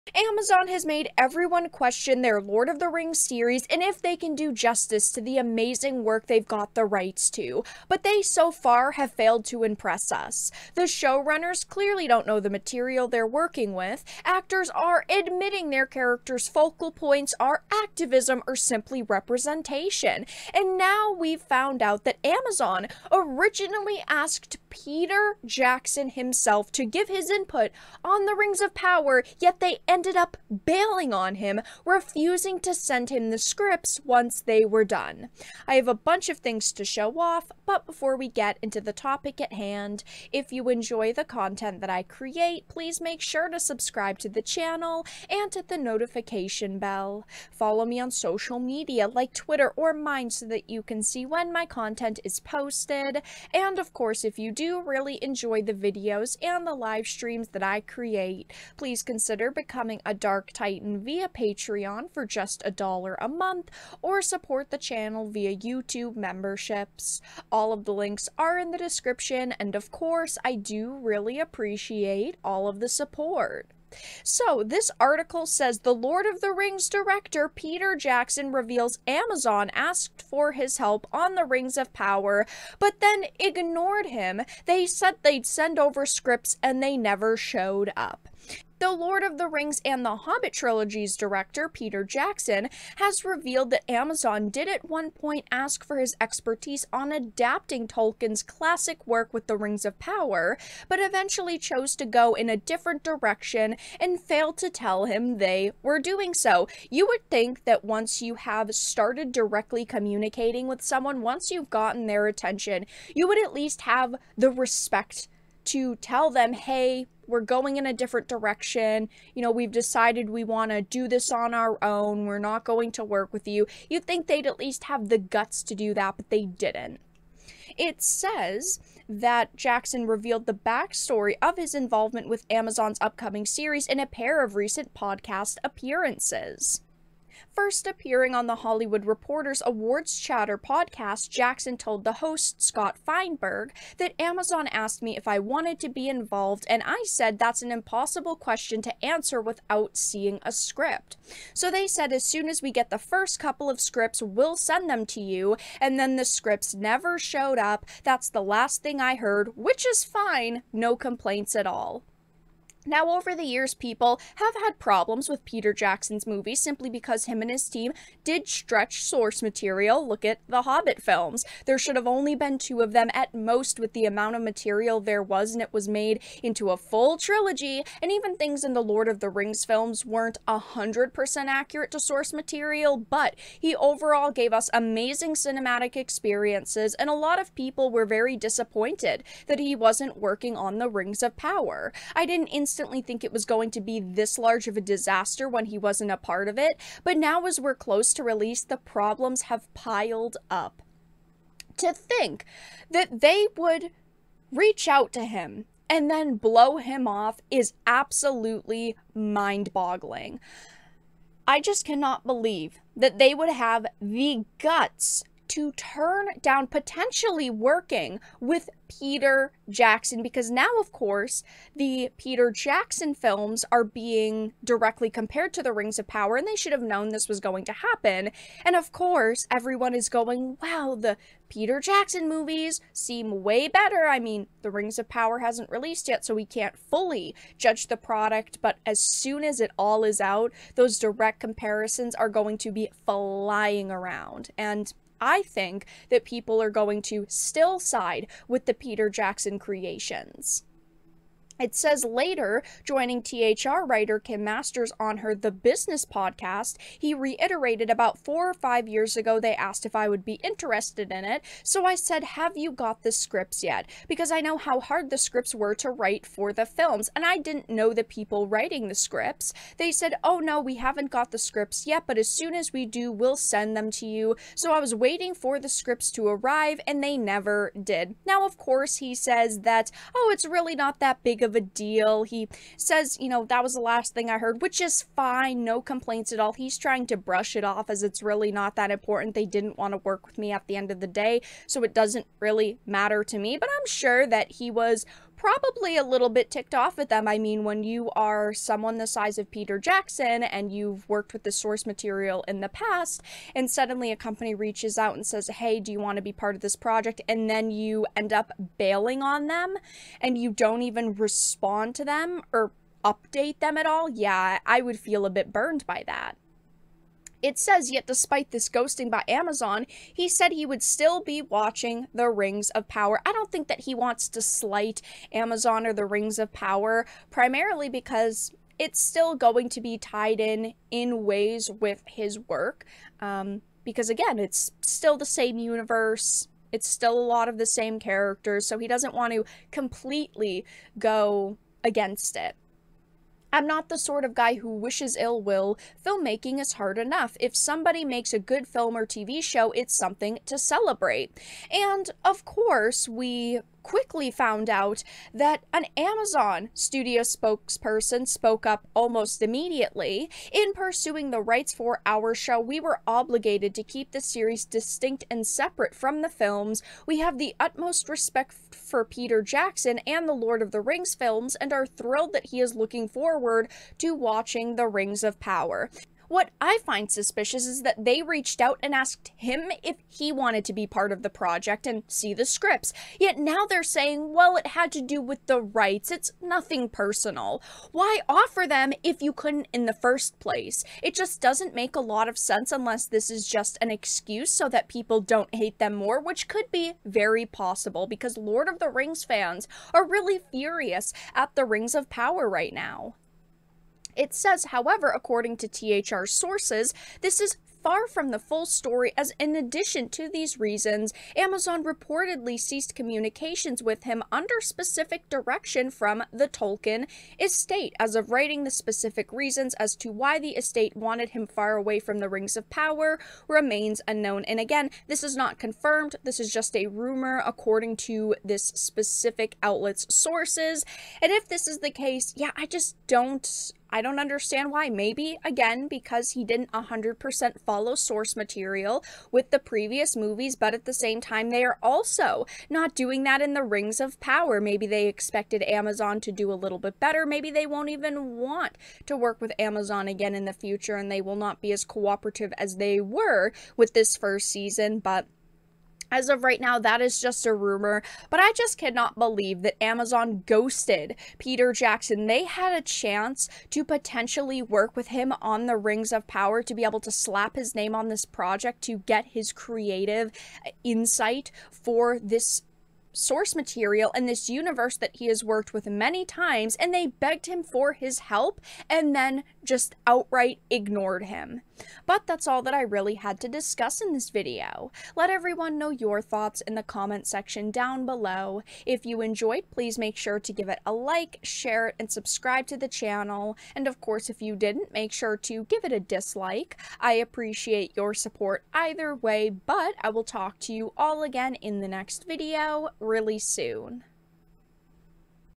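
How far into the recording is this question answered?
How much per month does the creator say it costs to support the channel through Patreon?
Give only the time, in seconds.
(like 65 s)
62 s.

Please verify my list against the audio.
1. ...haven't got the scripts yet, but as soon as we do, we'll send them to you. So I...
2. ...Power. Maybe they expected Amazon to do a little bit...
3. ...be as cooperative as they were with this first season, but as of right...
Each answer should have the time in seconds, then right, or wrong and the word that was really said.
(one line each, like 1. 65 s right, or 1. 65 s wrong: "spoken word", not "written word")
1. 270 s right
2. 444 s right
3. 451 s right.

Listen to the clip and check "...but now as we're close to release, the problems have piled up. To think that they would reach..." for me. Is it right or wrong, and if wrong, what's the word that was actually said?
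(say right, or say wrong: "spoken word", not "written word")
right.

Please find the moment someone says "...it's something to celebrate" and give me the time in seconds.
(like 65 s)
349 s.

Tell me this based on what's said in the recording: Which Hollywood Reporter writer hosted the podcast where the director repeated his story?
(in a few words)
Kim Masters.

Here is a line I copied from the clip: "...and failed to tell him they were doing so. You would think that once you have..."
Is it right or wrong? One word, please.
right.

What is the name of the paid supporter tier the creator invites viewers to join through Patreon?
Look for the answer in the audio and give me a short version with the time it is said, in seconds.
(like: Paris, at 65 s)
Dark Titan, at 60 s.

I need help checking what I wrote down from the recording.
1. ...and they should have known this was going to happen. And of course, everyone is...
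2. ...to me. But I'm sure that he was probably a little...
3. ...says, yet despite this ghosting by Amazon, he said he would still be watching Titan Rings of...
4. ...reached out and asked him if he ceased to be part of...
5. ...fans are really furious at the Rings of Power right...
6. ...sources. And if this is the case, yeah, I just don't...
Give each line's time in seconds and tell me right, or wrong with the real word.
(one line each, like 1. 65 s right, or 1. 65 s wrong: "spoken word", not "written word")
1. 226 s right
2. 293 s right
3. 317 s wrong: "The", not "Titan"
4. 378 s wrong: "wanted", not "ceased"
5. 399 s right
6. 430 s right.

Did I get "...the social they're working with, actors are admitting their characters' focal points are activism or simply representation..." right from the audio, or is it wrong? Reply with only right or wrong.
wrong.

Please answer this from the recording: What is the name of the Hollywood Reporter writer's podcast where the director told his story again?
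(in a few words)
The Business.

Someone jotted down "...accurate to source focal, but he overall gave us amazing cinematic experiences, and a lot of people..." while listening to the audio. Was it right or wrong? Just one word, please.
wrong.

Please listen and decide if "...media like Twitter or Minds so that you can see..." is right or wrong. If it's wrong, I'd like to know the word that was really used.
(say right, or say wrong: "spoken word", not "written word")
right.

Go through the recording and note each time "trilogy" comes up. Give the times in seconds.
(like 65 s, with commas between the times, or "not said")
90 s, 177 s.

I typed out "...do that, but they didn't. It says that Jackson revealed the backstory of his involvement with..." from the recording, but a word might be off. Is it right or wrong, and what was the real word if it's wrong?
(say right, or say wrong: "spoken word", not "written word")
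right.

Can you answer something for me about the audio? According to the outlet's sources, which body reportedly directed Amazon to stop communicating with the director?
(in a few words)
the Tolkien estate.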